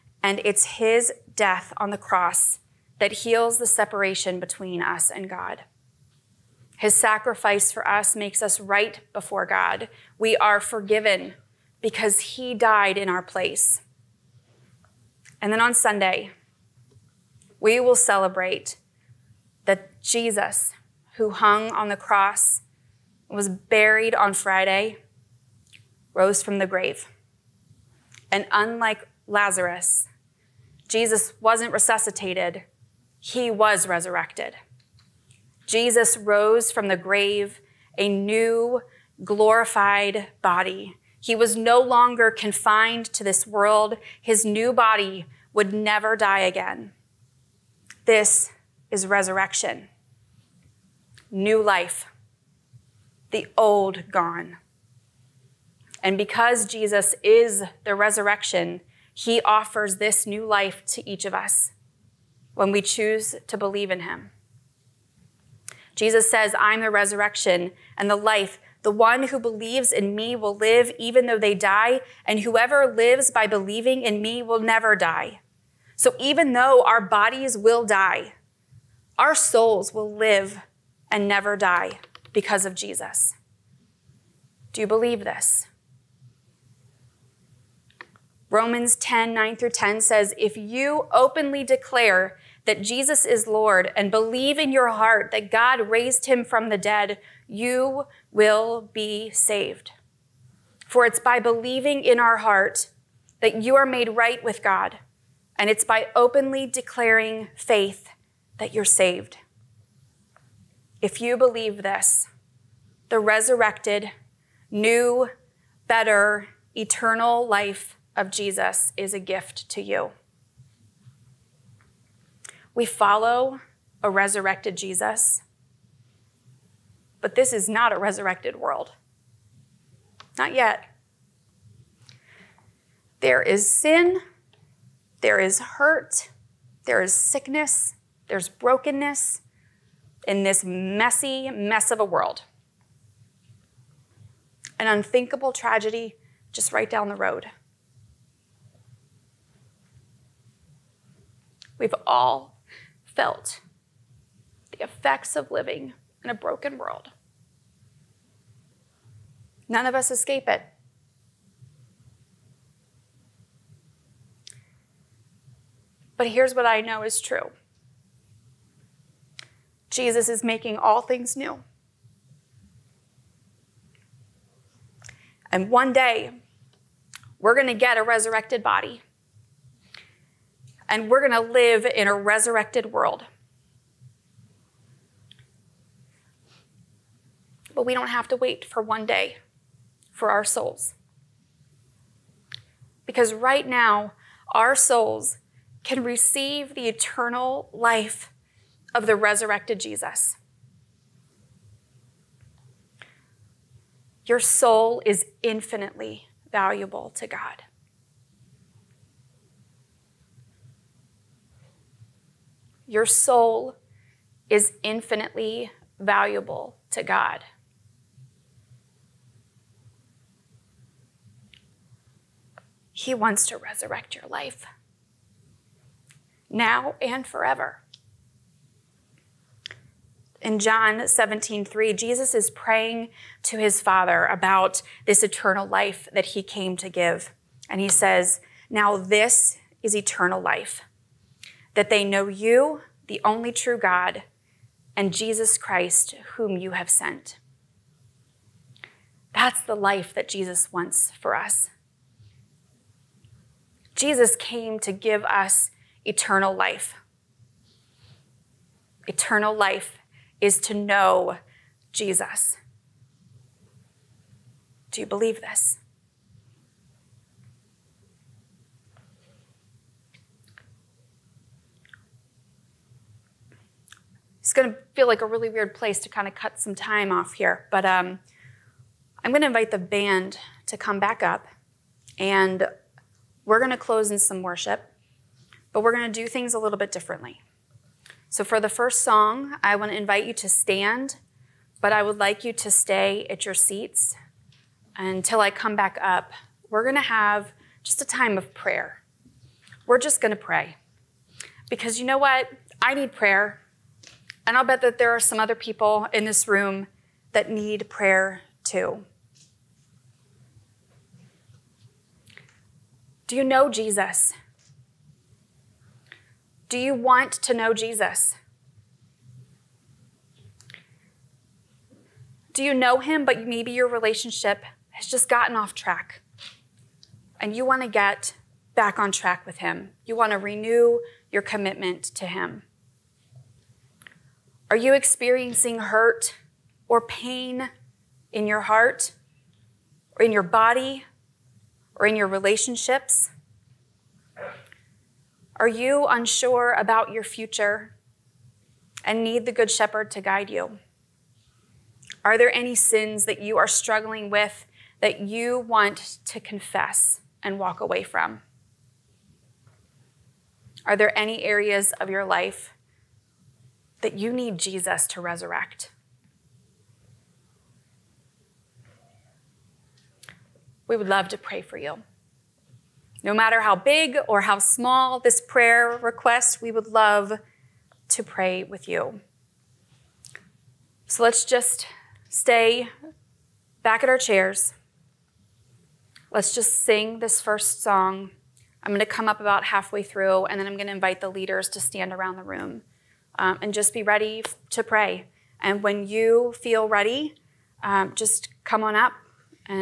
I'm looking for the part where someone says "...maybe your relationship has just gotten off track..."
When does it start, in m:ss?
5:23.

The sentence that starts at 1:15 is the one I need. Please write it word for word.
So even though our bodies will die, our souls will live and never die because of Jesus.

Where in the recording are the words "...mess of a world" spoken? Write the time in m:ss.
2:21.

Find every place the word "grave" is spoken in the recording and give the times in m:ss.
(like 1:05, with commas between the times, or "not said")
0:26, 0:36.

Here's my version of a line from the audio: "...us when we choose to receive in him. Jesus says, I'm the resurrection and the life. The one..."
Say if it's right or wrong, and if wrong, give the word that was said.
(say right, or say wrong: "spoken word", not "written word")
wrong: "believe", not "receive".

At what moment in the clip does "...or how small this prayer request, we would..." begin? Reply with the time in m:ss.
6:14.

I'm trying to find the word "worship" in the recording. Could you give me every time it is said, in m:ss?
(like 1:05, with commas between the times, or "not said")
4:44.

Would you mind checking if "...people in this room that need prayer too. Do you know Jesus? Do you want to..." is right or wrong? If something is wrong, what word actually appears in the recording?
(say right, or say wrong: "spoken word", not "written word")
right.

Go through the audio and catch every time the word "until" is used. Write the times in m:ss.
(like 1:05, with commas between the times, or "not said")
4:54.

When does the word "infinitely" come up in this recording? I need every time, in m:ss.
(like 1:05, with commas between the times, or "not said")
3:25, 3:34.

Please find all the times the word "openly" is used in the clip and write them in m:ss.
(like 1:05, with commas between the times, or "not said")
1:31, 1:46.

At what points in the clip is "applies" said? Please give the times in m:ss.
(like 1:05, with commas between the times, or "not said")
not said.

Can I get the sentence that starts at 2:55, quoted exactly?
And one day, we're going to get a resurrected body and we're going to live in a resurrected world.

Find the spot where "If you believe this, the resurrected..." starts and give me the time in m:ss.
1:51.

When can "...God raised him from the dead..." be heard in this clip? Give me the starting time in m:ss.
1:35.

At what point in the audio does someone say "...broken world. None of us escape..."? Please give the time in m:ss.
2:36.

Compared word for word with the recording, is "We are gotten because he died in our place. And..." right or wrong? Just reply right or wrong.
wrong.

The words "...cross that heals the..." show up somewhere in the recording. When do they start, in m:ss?
0:01.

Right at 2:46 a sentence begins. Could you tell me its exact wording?
But here's what I know is true Jesus is making all things new.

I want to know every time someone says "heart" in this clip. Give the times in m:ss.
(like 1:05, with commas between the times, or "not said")
1:34, 1:42, 5:38.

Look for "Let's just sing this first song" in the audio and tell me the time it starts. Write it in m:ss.
6:26.